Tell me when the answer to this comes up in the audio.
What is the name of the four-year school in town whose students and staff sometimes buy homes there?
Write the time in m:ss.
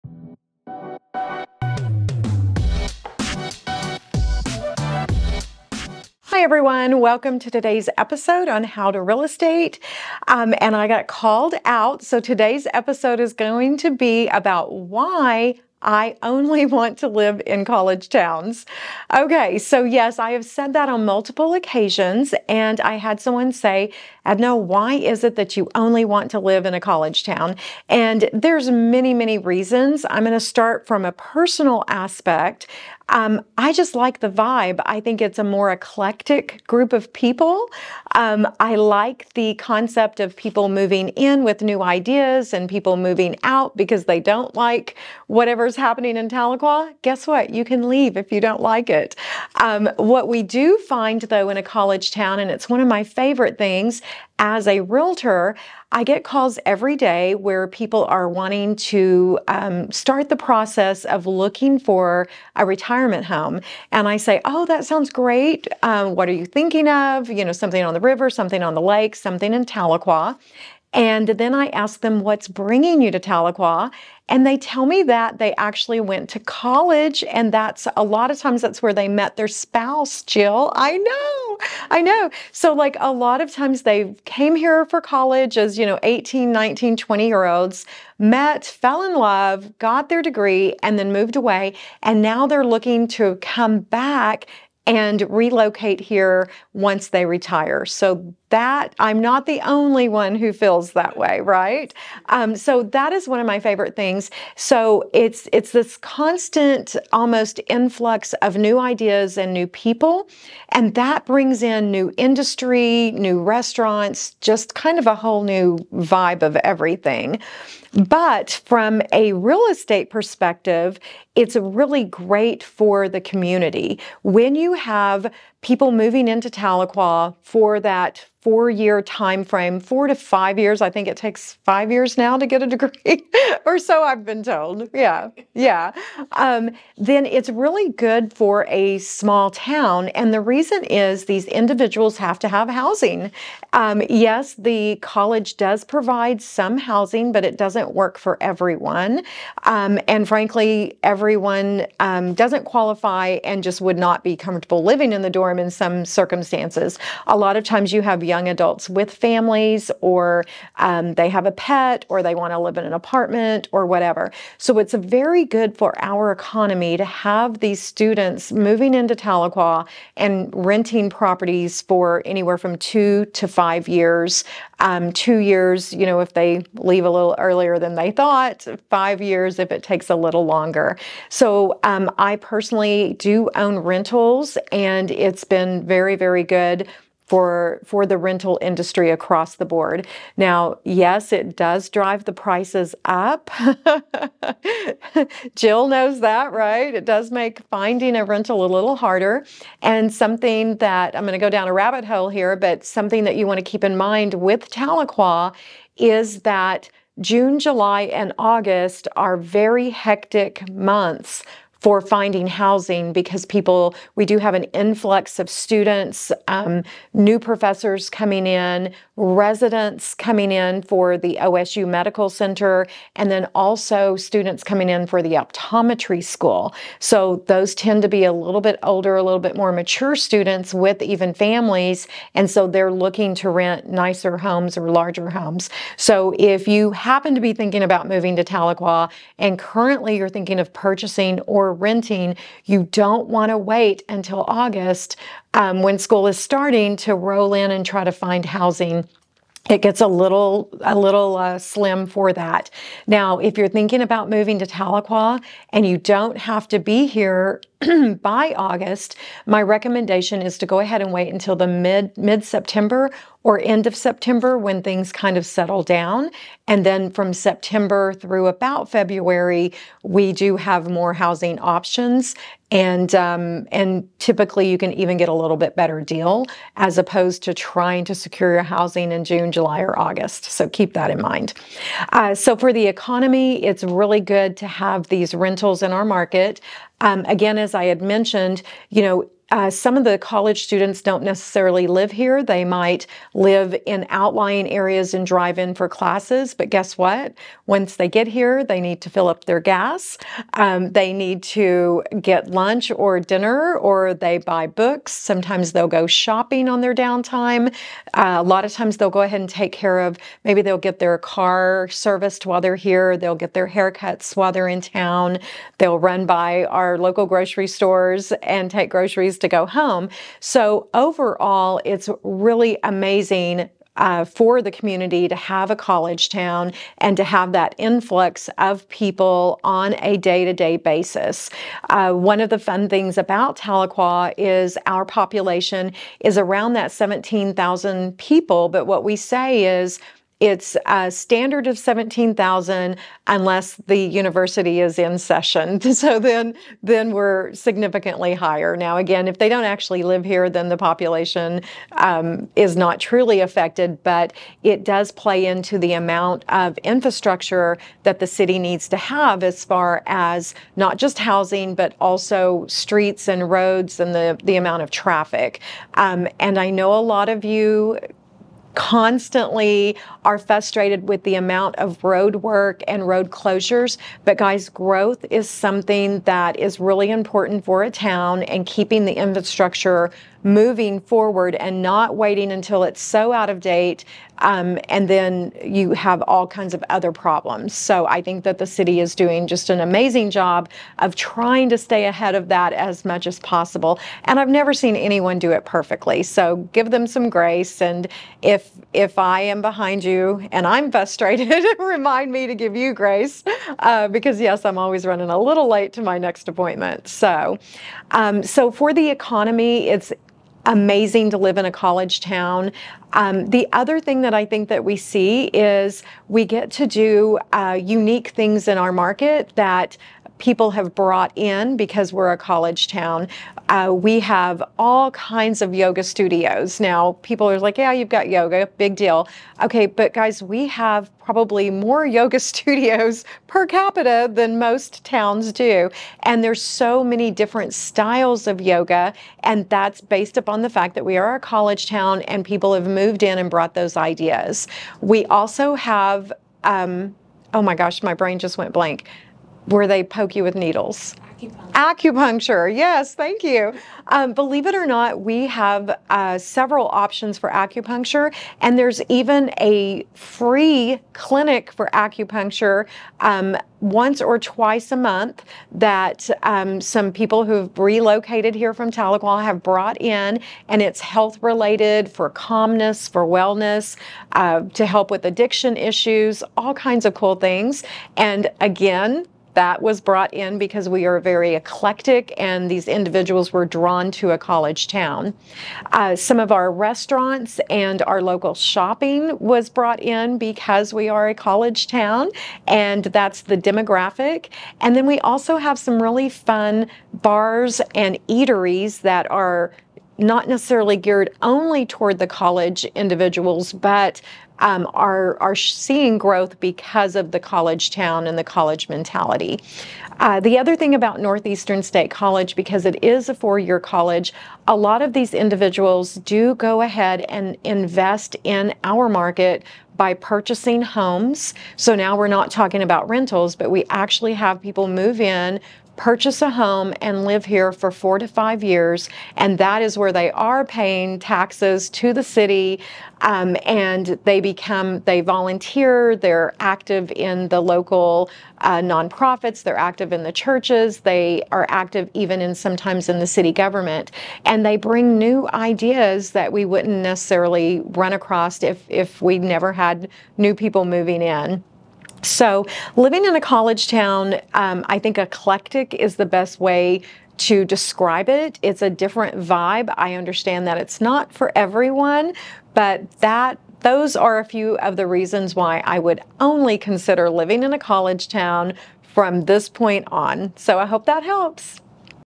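8:31.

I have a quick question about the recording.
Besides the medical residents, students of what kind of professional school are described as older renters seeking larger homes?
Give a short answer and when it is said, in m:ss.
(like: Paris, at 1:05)
optometry school, at 3:45.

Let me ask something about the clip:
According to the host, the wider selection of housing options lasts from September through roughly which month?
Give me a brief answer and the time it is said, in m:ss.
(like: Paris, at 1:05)
February, at 4:28.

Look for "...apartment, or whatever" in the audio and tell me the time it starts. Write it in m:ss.
2:42.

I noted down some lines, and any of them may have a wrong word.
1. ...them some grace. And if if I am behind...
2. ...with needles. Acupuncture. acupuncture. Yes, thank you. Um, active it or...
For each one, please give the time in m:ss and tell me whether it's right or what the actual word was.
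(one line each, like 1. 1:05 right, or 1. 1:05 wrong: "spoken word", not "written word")
1. 6:36 right
2. 7:30 wrong: "believe", not "active".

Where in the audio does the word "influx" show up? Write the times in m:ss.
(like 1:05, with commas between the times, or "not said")
1:47, 3:34, 5:27.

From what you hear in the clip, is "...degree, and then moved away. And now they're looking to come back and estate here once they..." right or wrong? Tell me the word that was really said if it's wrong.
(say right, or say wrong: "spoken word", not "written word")
wrong: "relocate", not "estate".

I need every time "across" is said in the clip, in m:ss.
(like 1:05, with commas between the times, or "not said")
3:09, 9:08.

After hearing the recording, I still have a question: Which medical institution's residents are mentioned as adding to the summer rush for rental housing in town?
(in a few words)
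OSU Medical Center.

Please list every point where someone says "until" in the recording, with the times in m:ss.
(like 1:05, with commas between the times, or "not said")
4:04, 4:21, 6:22.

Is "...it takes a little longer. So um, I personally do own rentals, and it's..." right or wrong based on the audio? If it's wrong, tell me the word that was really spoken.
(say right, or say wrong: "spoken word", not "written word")
right.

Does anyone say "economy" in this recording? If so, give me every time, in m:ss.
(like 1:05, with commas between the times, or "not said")
2:46, 4:42, 6:49.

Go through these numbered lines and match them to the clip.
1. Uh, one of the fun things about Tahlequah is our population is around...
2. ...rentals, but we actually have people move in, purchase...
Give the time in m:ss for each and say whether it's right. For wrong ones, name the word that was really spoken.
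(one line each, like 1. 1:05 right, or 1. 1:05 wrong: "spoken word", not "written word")
1. 5:31 right
2. 8:43 right.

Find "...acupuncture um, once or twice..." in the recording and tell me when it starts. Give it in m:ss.
7:41.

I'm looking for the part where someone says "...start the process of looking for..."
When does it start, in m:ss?
0:59.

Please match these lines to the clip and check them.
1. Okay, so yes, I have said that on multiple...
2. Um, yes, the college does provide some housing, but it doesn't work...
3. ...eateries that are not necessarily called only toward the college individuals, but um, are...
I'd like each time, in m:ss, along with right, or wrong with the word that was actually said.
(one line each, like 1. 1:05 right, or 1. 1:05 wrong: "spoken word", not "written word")
1. 0:19 right
2. 2:23 right
3. 8:18 wrong: "geared", not "called".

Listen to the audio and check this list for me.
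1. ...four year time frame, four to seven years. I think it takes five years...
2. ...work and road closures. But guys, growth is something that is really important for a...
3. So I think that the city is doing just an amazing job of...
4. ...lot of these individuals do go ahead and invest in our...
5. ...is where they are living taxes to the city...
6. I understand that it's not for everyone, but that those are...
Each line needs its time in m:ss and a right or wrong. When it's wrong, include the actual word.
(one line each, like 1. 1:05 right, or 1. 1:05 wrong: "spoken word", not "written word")
1. 2:08 wrong: "five", not "seven"
2. 6:12 right
3. 6:27 right
4. 8:34 right
5. 8:49 wrong: "paying", not "living"
6. 9:19 right.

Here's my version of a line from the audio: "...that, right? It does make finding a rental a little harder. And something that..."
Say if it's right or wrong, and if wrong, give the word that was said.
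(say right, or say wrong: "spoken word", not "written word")
right.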